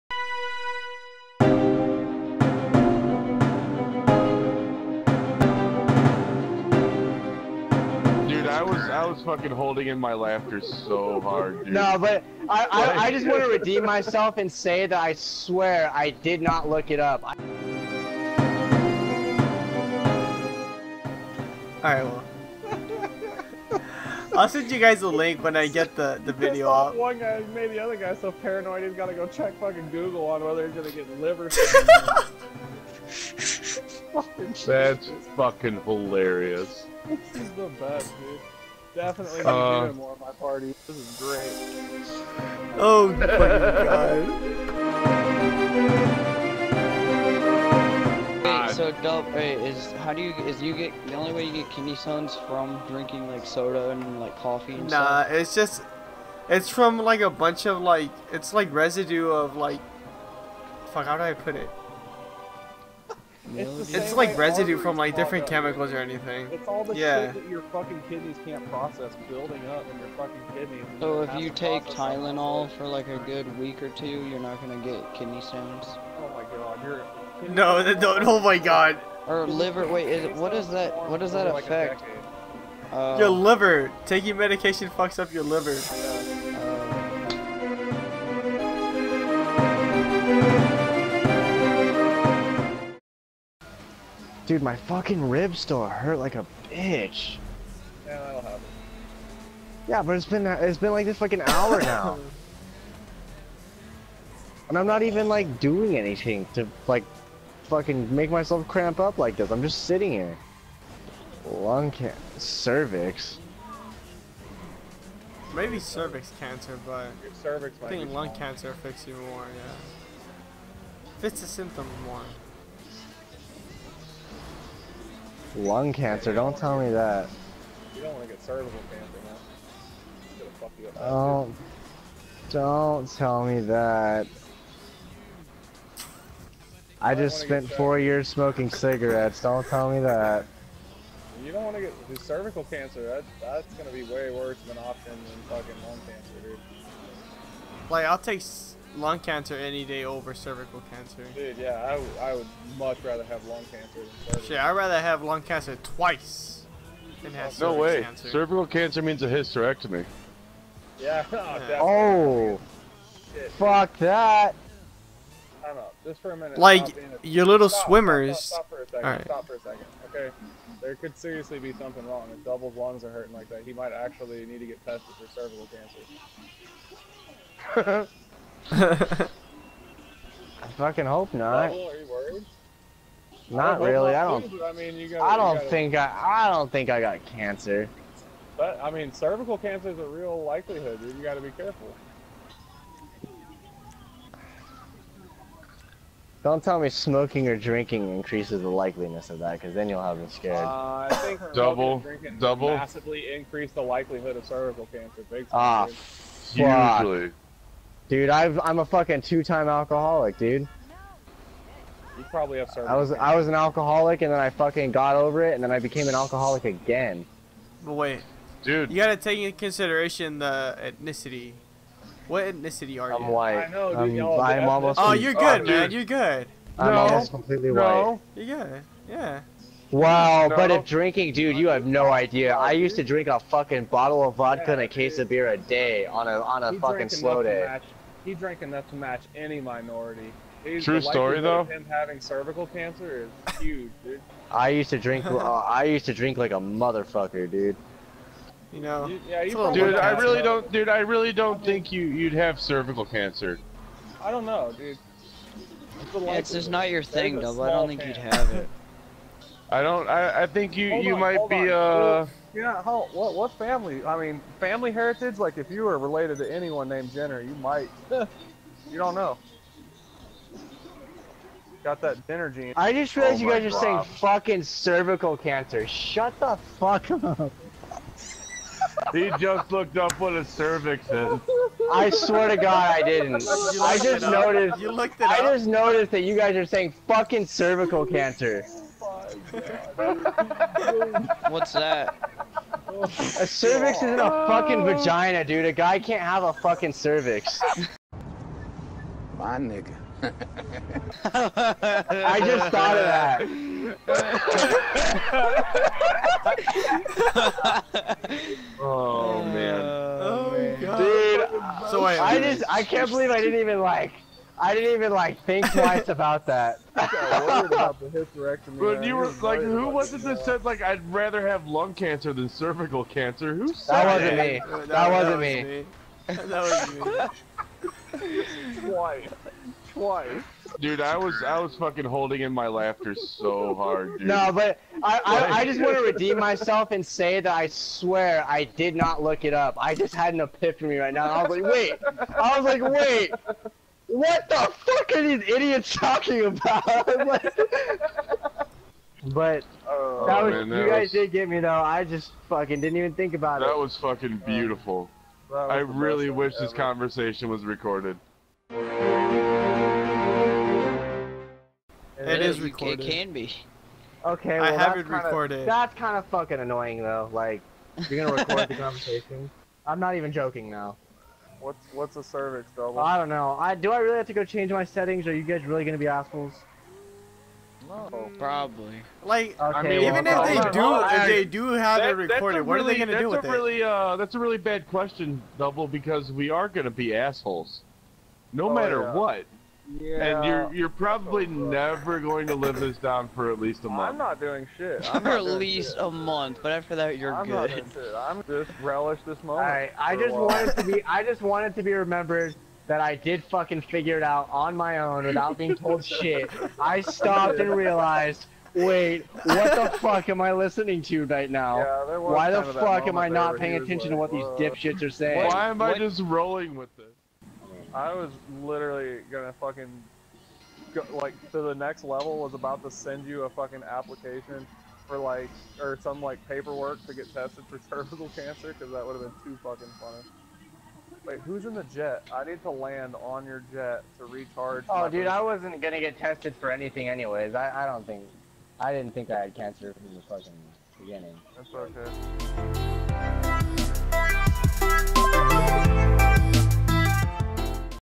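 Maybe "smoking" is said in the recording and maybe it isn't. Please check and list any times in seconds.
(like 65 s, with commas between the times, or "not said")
138 s, 196 s.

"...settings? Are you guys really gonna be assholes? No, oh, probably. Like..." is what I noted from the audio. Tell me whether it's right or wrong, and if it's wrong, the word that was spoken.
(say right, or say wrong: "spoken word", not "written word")
right.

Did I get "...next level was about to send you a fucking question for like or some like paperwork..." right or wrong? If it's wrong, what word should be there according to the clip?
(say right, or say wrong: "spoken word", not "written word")
wrong: "application", not "question".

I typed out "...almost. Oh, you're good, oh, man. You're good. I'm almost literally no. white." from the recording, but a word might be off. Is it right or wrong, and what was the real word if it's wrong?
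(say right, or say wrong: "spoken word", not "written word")
wrong: "completely", not "literally".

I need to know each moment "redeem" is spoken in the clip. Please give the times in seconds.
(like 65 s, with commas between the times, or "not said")
13 s, 336 s.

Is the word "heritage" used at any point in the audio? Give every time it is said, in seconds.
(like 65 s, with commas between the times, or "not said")
264 s.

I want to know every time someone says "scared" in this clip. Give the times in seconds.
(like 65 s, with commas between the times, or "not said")
200 s.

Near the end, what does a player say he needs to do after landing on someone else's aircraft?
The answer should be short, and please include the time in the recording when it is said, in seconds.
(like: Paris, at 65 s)
Recharge, at 434 s.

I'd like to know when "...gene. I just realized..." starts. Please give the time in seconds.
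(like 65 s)
272 s.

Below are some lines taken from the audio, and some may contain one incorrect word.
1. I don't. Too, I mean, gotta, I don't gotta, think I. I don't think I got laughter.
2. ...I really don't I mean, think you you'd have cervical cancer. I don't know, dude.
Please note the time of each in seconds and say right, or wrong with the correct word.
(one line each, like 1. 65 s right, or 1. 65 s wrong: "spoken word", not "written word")
1. 184 s wrong: "cancer", not "laughter"
2. 250 s right.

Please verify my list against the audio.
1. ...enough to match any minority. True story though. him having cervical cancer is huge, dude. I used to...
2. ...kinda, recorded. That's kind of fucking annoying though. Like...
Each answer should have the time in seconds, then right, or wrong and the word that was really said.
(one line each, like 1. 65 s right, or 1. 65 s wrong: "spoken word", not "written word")
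1. 238 s right
2. 365 s right.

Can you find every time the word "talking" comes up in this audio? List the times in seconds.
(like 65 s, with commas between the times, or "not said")
345 s.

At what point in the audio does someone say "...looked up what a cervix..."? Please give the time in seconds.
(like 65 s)
279 s.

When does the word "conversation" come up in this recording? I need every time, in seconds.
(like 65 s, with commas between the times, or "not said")
356 s, 368 s.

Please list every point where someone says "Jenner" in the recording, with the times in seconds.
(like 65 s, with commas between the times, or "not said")
267 s, 272 s.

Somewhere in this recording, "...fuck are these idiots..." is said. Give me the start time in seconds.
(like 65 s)
344 s.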